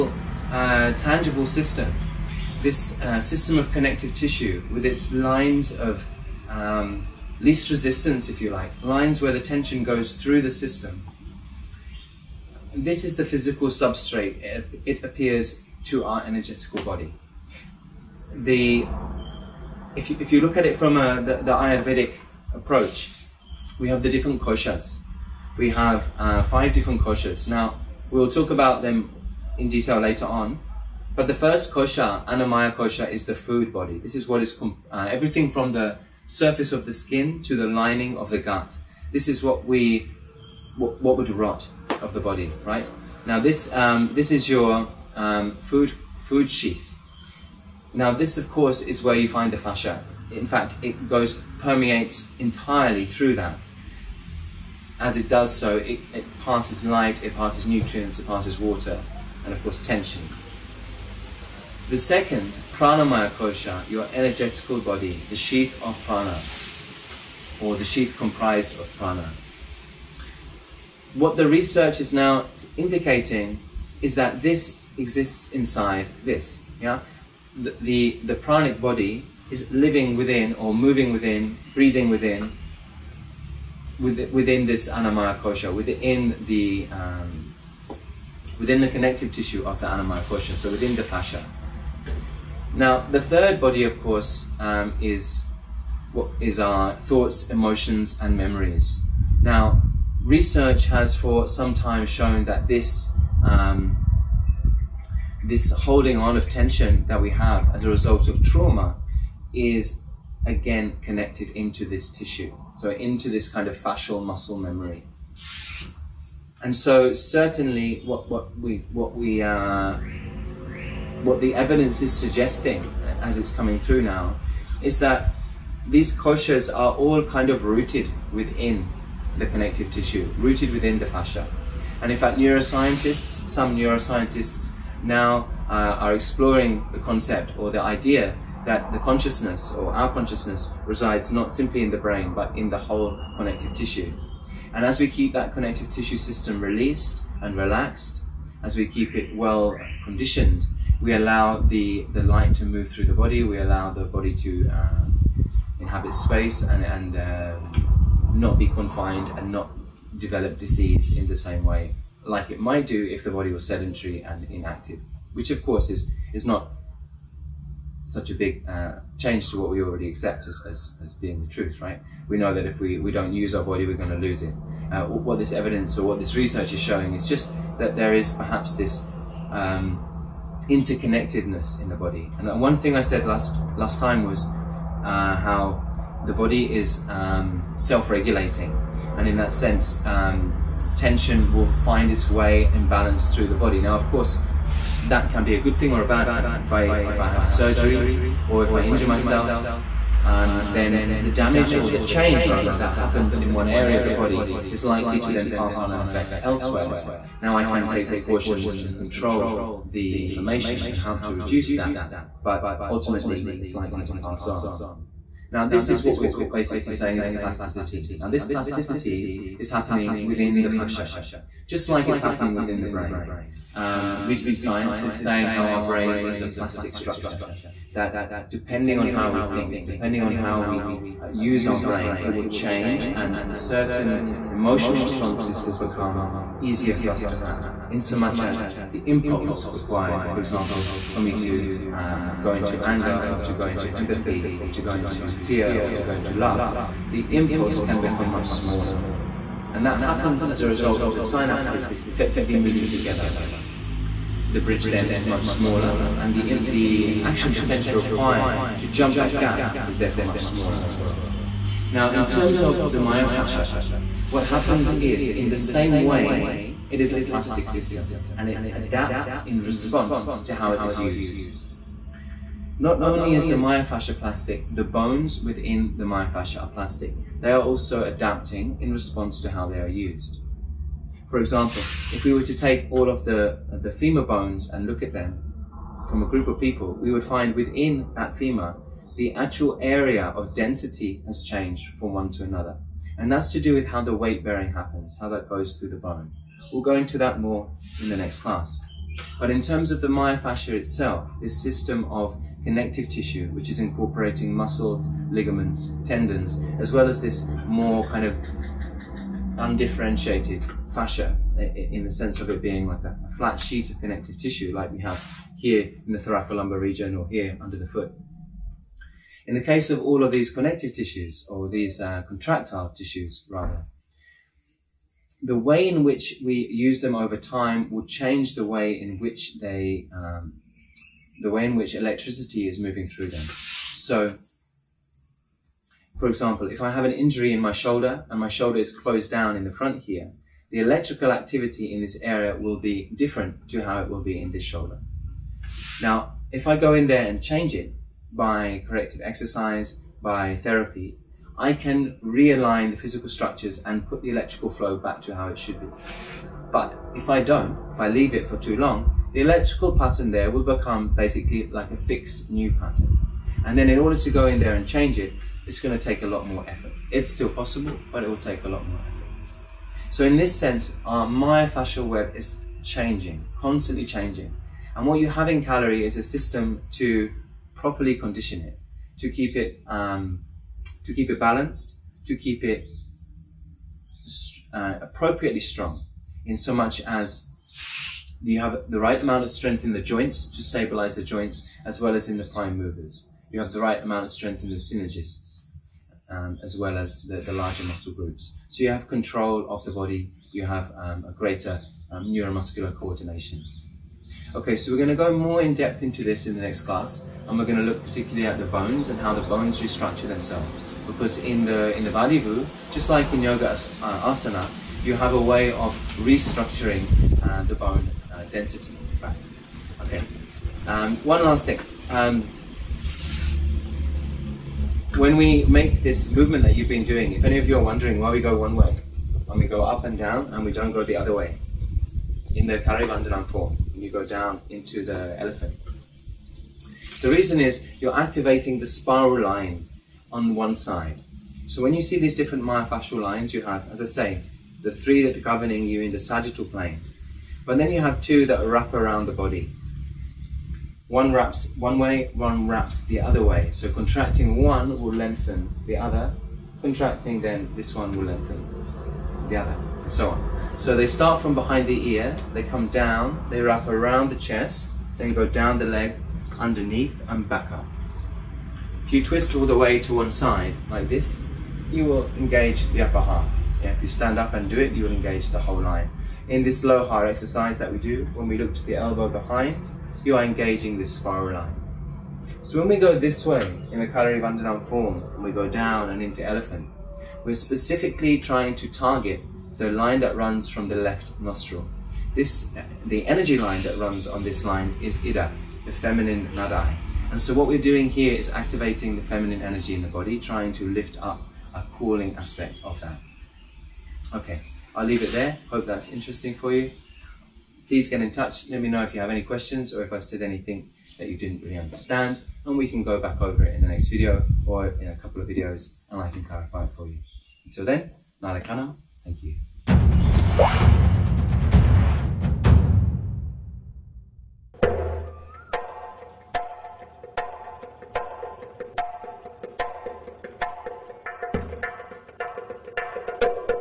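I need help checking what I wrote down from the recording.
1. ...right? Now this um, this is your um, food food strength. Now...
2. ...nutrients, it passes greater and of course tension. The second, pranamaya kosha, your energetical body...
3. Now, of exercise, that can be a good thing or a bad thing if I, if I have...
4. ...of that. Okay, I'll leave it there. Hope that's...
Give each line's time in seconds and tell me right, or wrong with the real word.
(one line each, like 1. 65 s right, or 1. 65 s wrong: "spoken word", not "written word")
1. 42 s wrong: "sheath", not "strength"
2. 57 s wrong: "water", not "greater"
3. 193 s wrong: "course", not "exercise"
4. 502 s right.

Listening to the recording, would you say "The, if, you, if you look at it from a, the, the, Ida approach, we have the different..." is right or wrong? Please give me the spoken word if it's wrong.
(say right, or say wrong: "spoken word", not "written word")
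wrong: "Ayurvedic", not "Ida".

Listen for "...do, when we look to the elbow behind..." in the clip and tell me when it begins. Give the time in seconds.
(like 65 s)
477 s.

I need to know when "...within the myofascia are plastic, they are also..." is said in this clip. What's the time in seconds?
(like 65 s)
275 s.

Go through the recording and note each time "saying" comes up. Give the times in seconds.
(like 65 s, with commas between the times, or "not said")
216 s, 225 s.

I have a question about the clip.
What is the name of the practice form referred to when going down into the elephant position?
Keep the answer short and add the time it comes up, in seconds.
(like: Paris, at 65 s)
Parivandanam, at 432 s.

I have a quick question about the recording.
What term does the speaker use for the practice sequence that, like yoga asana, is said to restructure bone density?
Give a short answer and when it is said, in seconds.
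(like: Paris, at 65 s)
Vadivu, at 412 s.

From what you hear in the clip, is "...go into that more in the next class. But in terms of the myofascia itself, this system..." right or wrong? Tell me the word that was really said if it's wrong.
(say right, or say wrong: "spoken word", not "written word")
right.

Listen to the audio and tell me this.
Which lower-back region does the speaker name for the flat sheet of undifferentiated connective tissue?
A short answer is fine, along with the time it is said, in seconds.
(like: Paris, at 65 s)
Thoracolumbar region, at 316 s.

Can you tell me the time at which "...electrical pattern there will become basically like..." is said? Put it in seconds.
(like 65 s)
359 s.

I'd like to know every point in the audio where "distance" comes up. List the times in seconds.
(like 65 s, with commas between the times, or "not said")
not said.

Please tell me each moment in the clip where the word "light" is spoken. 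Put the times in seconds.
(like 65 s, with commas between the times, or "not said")
56 s, 152 s.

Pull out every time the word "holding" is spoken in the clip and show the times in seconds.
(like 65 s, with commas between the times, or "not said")
105 s.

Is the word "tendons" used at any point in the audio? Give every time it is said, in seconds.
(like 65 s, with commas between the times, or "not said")
306 s.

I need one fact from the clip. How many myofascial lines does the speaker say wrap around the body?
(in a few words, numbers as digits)
2.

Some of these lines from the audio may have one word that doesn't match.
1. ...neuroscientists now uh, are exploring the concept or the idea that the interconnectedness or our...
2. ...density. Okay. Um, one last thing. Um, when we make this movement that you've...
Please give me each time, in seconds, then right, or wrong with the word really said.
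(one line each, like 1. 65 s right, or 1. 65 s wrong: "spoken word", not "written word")
1. 133 s wrong: "consciousness", not "interconnectedness"
2. 418 s right.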